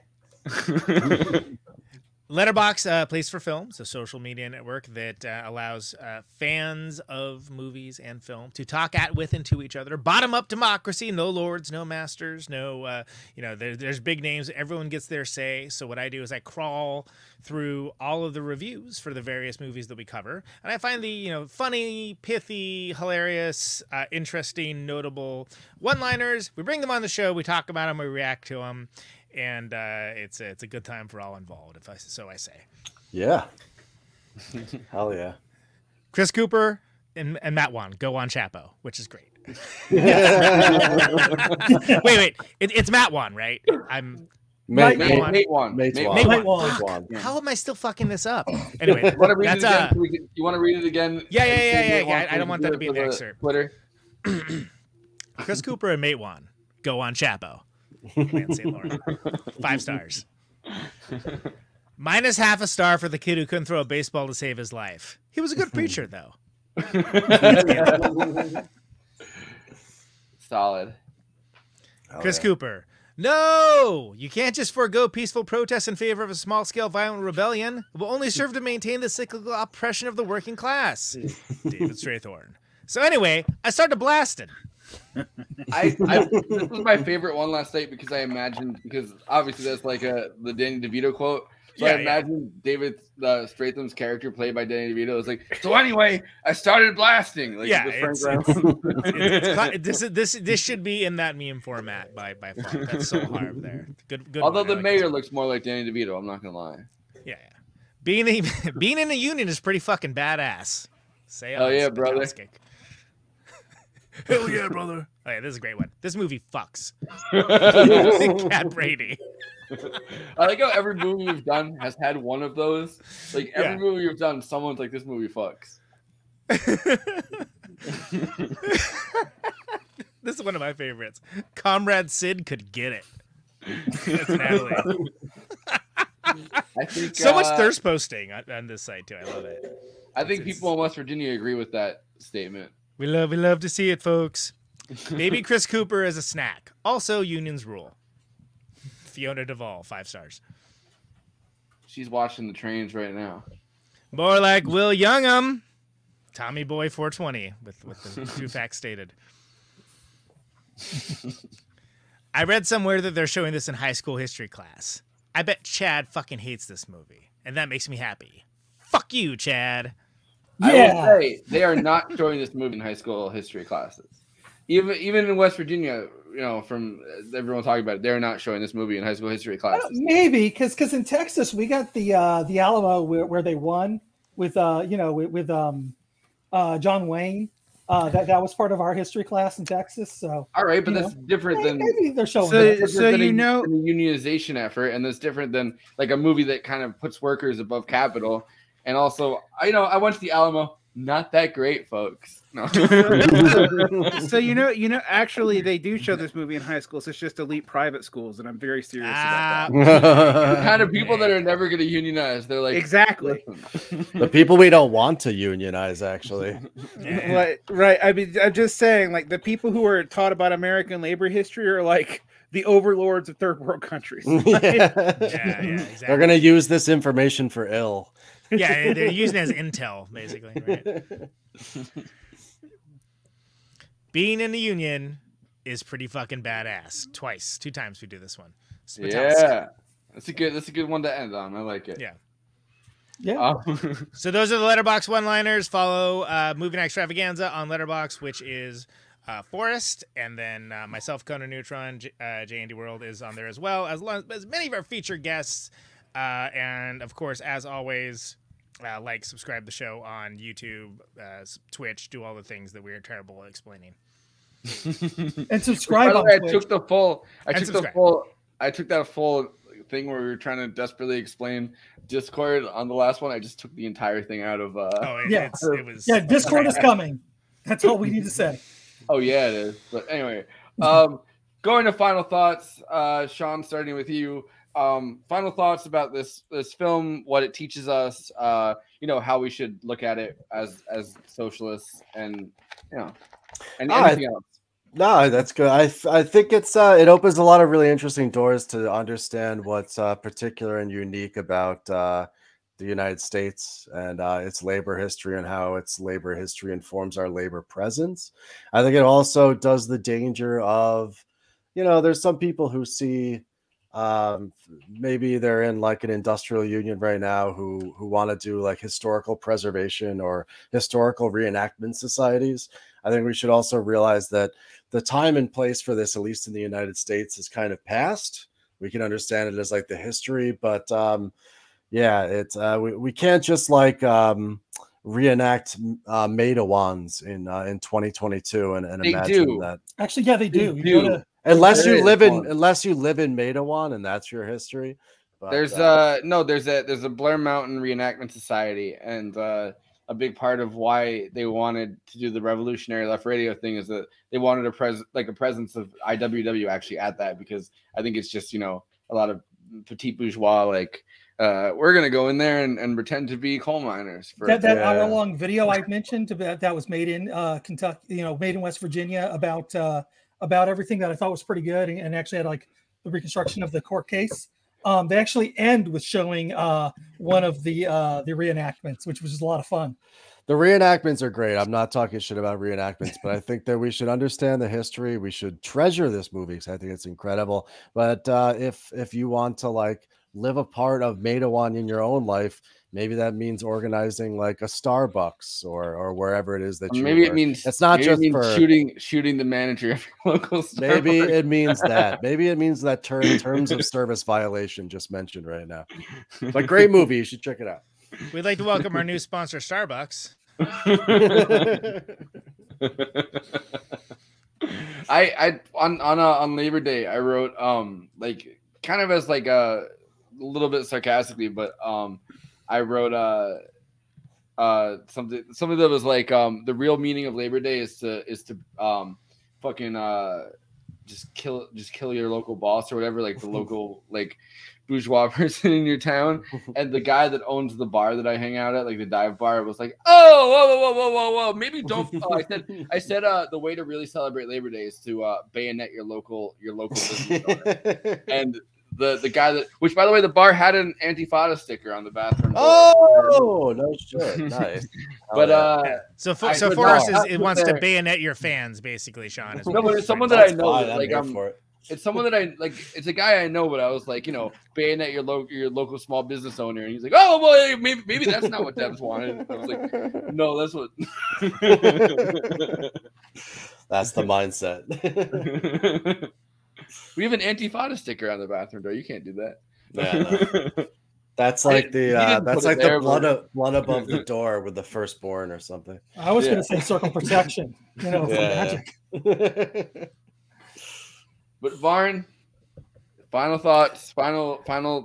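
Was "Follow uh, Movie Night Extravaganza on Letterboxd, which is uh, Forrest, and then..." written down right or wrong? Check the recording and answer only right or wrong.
right.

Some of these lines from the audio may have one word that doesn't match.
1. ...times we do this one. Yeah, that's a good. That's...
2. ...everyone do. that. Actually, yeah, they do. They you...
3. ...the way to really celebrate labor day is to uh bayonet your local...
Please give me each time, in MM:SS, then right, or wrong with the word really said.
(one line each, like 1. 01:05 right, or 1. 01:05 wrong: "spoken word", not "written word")
1. 03:57 right
2. 05:39 wrong: "imagine", not "everyone"
3. 07:23 right.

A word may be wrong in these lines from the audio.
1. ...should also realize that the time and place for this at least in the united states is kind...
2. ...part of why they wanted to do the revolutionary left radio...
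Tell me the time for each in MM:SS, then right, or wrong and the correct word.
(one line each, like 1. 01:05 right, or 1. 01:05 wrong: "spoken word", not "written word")
1. 05:23 right
2. 05:50 right.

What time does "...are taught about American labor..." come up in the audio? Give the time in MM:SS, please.
03:39.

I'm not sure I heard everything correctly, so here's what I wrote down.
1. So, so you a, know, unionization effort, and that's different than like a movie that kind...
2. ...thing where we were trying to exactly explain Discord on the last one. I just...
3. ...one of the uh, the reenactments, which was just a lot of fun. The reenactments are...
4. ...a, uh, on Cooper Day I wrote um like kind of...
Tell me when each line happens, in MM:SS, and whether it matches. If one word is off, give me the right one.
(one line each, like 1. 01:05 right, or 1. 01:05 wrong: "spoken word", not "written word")
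1. 03:12 right
2. 04:29 wrong: "desperately", not "exactly"
3. 06:17 right
4. 06:56 wrong: "Labor", not "Cooper".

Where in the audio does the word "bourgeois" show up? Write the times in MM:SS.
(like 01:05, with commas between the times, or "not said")
06:00, 07:14.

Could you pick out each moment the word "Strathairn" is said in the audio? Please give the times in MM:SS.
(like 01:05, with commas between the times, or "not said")
01:21, 01:33.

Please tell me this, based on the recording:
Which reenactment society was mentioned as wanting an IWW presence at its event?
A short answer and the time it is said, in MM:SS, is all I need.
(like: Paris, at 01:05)
Blair Mountain Reenactment Society, at 05:47.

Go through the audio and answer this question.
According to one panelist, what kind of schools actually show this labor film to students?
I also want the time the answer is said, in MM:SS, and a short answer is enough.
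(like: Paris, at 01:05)
Elite private schools, at 03:27.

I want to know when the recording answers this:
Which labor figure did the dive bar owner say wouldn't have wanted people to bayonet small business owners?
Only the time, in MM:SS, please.
07:48.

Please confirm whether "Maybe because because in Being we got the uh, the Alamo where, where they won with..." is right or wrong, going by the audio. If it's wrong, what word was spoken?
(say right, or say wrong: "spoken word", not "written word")
wrong: "Texas", not "Being".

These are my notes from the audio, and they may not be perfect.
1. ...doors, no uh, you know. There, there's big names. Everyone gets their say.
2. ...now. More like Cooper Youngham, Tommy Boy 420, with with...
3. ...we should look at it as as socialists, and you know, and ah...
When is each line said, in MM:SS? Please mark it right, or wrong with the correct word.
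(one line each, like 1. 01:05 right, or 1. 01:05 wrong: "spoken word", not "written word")
1. 00:11 wrong: "masters", not "doors"
2. 02:33 wrong: "Will", not "Cooper"
3. 04:49 right.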